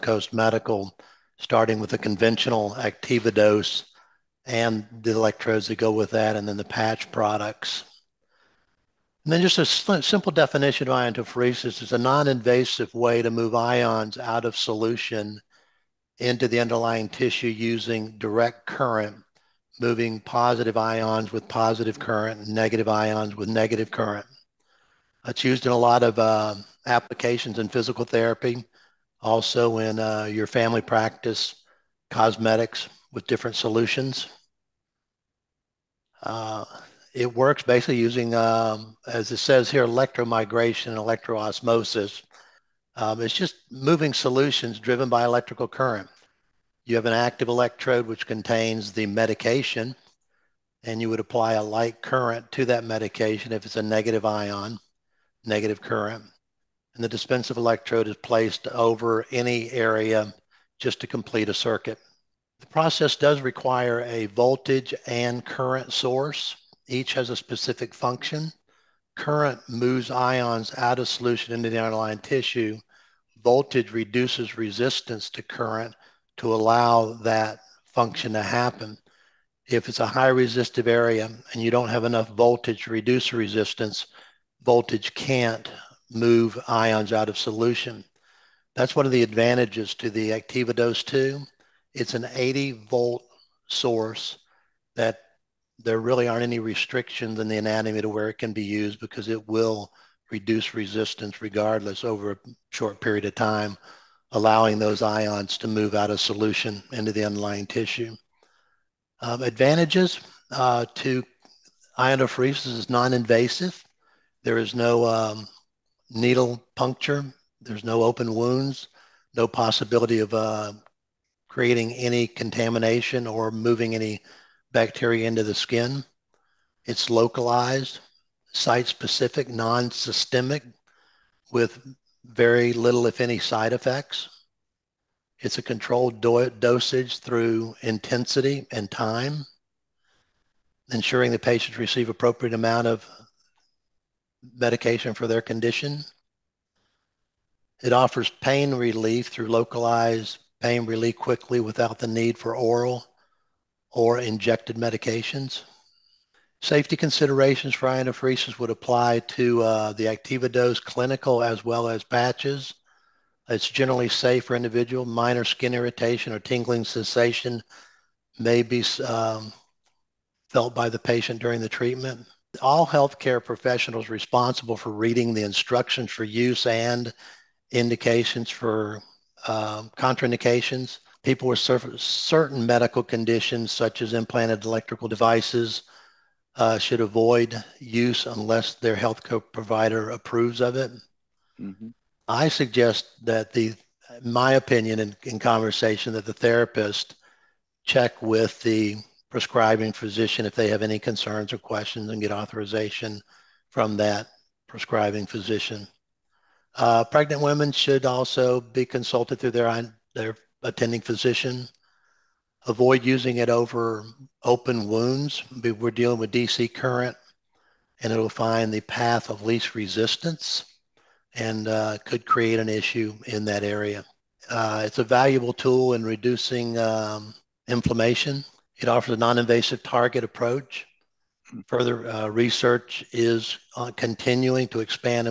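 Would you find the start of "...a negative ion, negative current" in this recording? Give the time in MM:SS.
00:53.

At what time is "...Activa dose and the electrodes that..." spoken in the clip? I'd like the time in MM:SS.
00:02.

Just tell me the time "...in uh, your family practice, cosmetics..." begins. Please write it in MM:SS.
00:29.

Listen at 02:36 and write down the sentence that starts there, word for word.
Safety considerations for ionophores would apply to uh, the Activa dose clinical as well as patches.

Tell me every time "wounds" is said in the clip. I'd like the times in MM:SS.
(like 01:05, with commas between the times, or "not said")
01:58, 03:34.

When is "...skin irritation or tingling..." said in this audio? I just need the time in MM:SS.
02:45.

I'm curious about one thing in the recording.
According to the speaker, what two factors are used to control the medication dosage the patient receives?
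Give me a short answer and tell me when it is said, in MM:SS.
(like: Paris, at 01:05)
Intensity and time, at 02:17.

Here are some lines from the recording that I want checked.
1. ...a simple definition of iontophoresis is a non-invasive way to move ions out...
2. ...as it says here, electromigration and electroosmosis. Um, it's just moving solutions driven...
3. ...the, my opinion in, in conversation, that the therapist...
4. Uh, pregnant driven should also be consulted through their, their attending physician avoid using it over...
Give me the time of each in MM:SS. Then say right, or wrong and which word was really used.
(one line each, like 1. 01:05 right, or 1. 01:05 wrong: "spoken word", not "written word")
1. 00:09 right
2. 00:39 right
3. 03:13 right
4. 03:26 wrong: "women", not "driven".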